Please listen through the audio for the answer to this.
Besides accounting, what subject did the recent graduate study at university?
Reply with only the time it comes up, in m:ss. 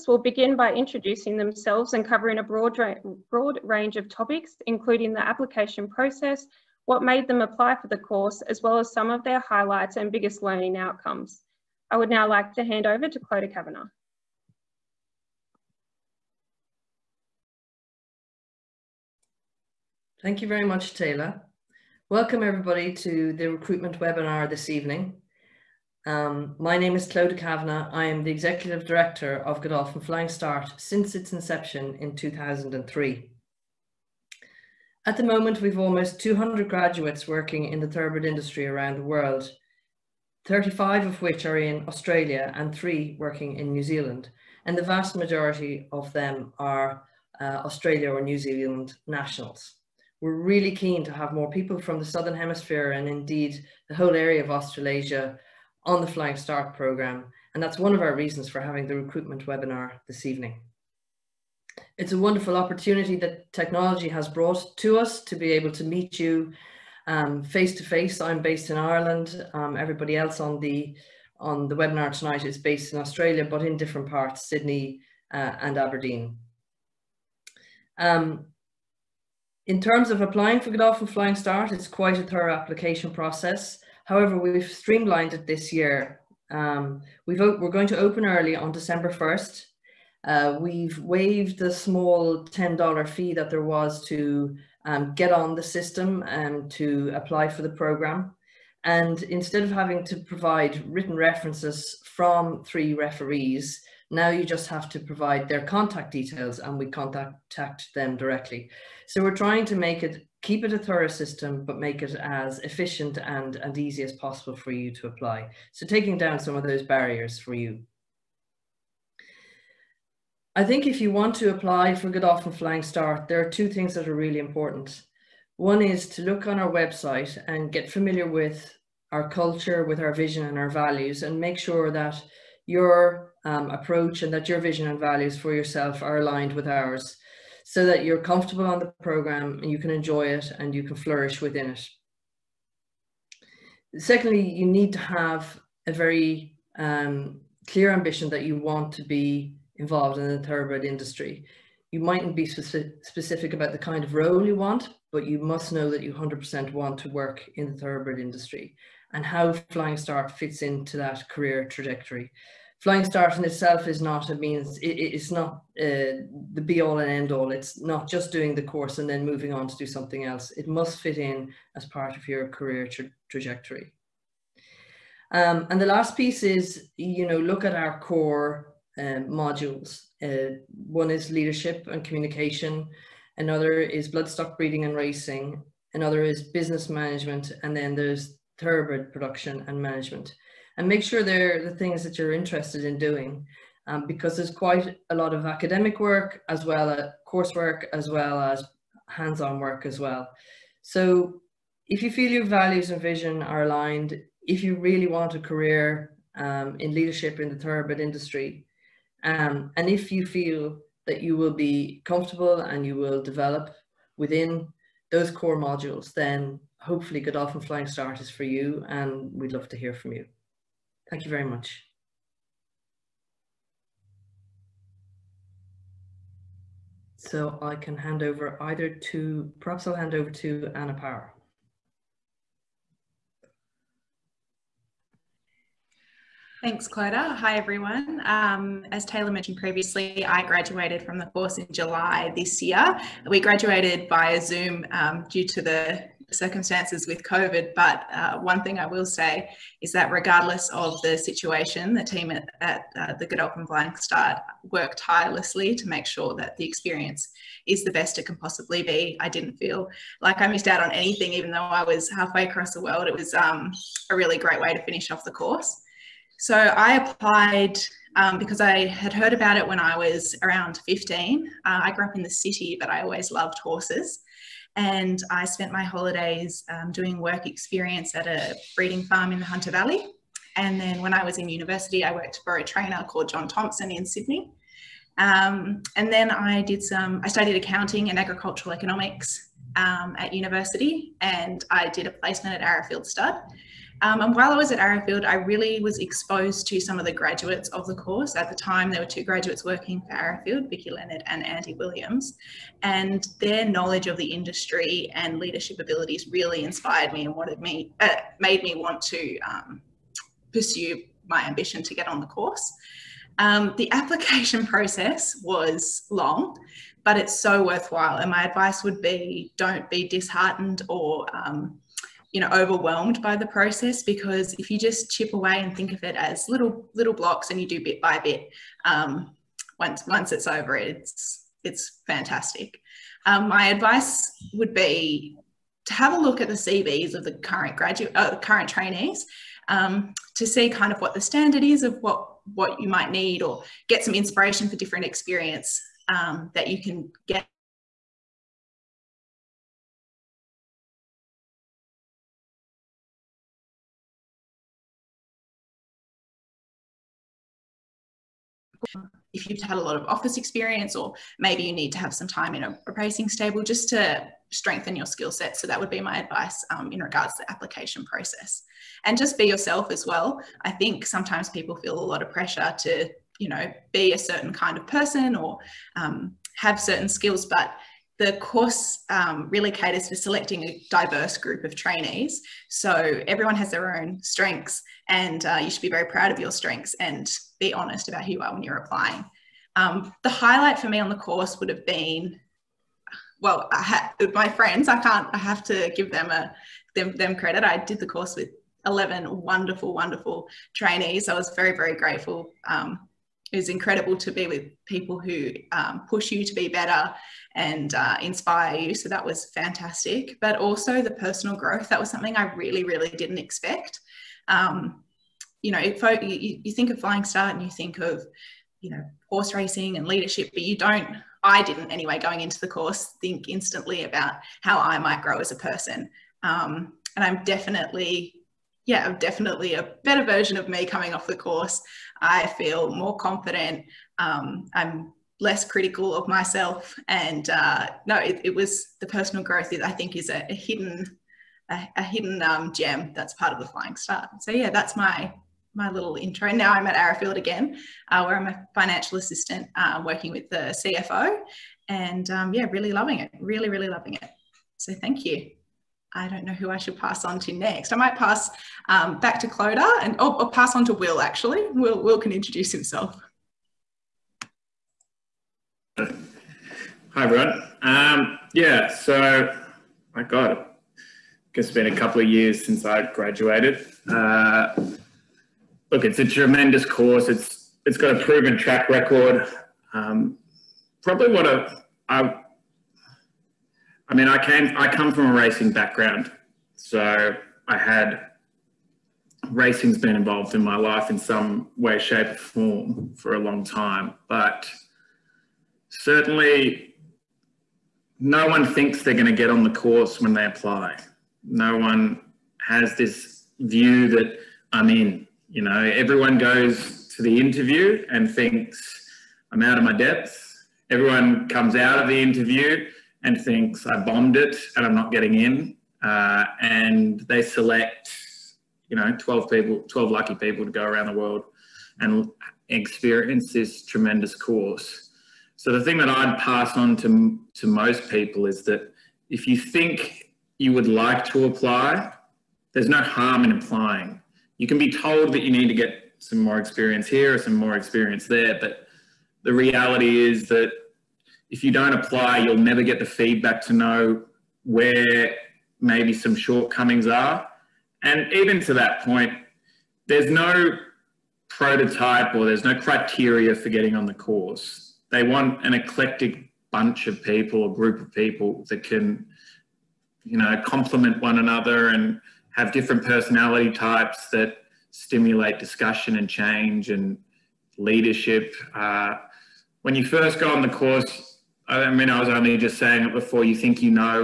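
4:48.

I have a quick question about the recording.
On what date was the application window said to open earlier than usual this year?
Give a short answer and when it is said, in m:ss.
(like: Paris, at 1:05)
December 1st, at 1:28.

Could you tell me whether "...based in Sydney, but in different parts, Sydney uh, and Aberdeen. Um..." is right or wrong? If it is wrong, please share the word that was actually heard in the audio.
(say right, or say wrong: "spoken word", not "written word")
wrong: "Australia", not "Sydney".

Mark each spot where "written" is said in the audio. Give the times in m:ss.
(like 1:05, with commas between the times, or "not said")
1:40.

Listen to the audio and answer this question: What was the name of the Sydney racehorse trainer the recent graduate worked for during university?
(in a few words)
John Thompson.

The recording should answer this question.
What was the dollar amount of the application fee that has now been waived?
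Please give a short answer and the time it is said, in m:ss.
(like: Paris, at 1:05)
$10, at 1:32.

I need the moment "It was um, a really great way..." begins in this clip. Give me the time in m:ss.
4:23.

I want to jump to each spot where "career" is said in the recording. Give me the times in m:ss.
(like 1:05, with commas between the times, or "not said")
2:41, 2:52, 3:25.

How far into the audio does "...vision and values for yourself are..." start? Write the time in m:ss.
2:14.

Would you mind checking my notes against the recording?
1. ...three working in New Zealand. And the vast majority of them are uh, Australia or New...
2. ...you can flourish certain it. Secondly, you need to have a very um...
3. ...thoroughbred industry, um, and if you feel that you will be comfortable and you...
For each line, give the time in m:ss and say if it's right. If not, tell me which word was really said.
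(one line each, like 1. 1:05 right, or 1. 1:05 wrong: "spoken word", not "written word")
1. 0:42 right
2. 2:20 wrong: "within", not "certain"
3. 3:27 right.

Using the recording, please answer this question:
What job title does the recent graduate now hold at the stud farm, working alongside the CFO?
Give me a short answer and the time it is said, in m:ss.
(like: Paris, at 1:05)
financial assistant, at 7:28.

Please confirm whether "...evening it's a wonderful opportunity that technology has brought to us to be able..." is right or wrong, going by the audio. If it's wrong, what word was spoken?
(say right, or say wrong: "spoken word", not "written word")
right.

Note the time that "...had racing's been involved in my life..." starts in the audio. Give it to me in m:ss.
8:07.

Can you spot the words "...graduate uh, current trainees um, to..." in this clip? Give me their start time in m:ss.
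5:37.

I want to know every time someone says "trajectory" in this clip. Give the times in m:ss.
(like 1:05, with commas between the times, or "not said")
2:41, 2:53.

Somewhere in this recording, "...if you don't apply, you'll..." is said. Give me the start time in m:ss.
9:01.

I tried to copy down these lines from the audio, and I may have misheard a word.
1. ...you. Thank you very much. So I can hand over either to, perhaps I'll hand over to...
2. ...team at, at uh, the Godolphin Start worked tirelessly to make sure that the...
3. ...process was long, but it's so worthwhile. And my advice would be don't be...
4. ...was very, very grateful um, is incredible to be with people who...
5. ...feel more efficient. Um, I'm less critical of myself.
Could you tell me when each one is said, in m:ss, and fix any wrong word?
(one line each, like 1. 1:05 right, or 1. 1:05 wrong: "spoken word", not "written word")
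1. 3:40 right
2. 4:12 right
3. 5:14 right
4. 6:41 right
5. 7:12 wrong: "confident", not "efficient".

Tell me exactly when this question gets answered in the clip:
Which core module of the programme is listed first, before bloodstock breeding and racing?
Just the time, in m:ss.
3:01.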